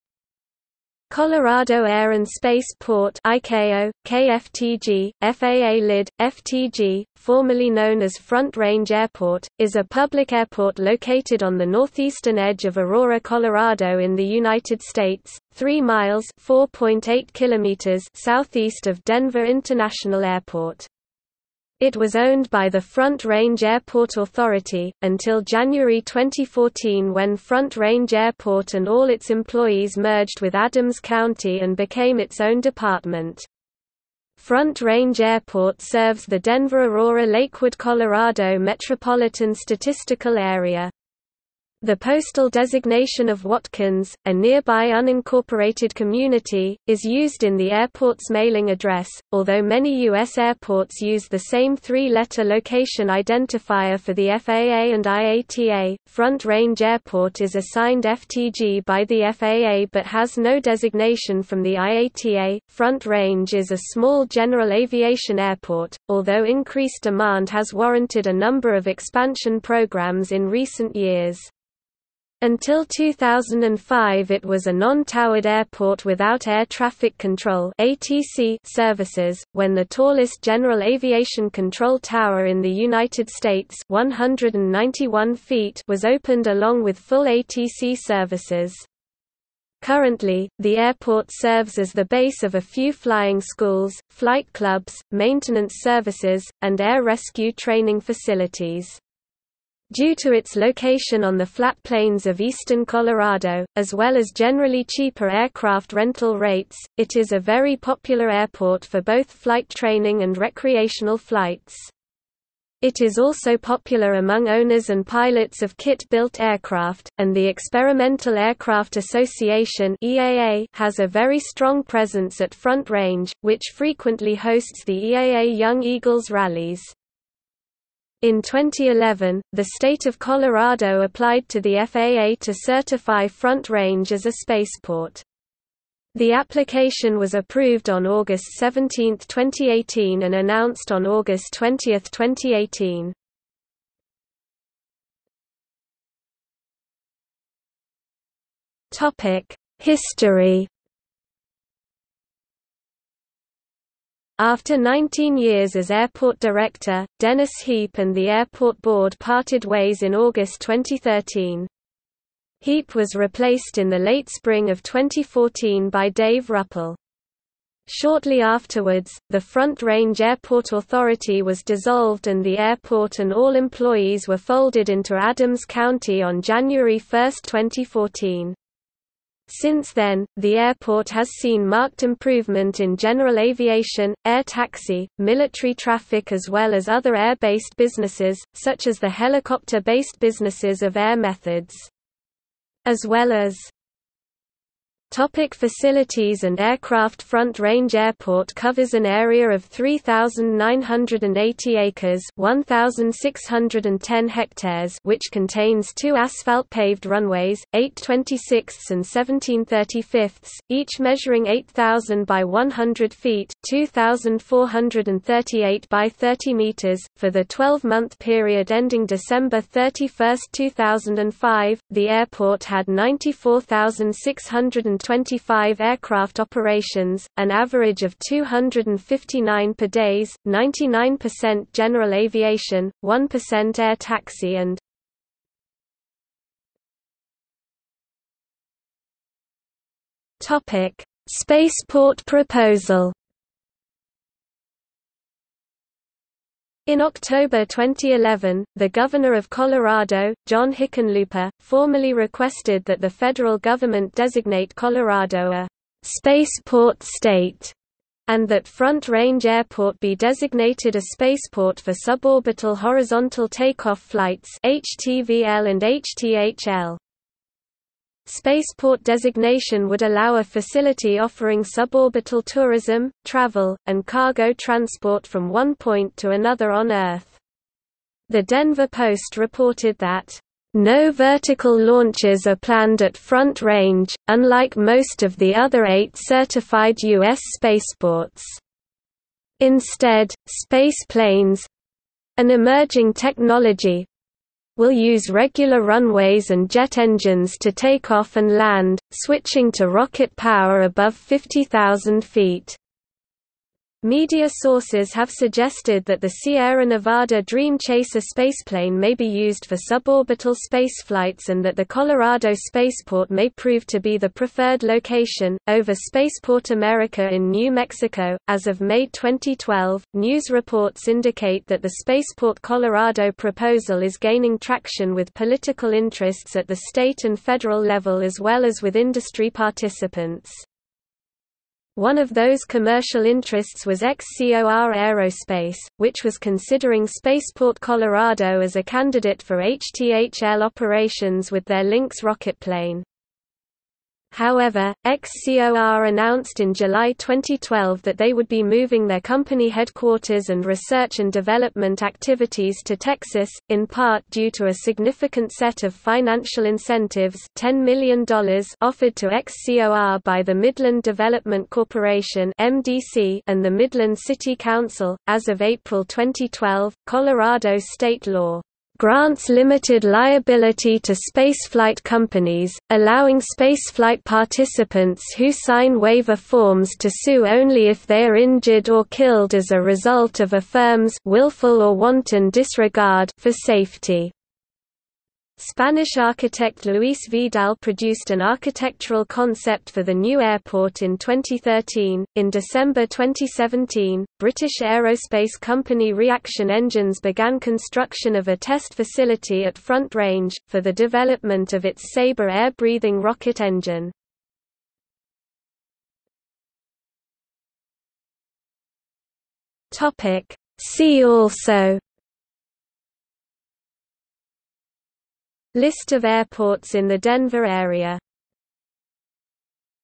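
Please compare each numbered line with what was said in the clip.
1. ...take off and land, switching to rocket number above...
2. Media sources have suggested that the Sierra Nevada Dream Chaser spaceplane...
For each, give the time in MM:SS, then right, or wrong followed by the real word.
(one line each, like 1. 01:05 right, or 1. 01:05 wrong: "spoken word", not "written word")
1. 04:57 wrong: "power", not "number"
2. 05:04 right.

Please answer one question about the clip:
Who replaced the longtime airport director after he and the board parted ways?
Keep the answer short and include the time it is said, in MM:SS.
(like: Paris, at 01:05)
Dave Ruppel, at 02:46.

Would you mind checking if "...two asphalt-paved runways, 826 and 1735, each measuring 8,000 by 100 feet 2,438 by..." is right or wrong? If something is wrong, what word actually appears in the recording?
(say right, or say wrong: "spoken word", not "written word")
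right.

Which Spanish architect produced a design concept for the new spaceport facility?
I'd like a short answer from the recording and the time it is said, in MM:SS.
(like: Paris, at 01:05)
Luis Vidal, at 06:26.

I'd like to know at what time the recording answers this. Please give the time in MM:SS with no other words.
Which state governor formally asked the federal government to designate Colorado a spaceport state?
04:10.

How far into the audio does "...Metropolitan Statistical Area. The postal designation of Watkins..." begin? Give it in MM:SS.
00:38.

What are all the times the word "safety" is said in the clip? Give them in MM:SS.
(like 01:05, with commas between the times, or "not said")
06:23.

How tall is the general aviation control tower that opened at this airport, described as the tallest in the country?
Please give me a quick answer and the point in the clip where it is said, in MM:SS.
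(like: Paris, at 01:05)
191 feet, at 01:23.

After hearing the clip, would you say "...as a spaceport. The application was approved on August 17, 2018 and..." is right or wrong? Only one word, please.
right.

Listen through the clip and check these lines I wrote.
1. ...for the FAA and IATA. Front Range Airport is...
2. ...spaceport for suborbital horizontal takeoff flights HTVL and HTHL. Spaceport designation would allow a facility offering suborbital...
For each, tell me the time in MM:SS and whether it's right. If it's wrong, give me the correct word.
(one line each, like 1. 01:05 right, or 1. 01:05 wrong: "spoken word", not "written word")
1. 00:53 right
2. 04:21 right.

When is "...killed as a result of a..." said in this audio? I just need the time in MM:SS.
06:19.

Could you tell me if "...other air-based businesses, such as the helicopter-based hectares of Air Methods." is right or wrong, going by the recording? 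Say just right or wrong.
wrong.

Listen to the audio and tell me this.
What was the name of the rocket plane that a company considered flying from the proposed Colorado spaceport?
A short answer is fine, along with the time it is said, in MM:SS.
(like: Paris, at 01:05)
Lynx, at 05:41.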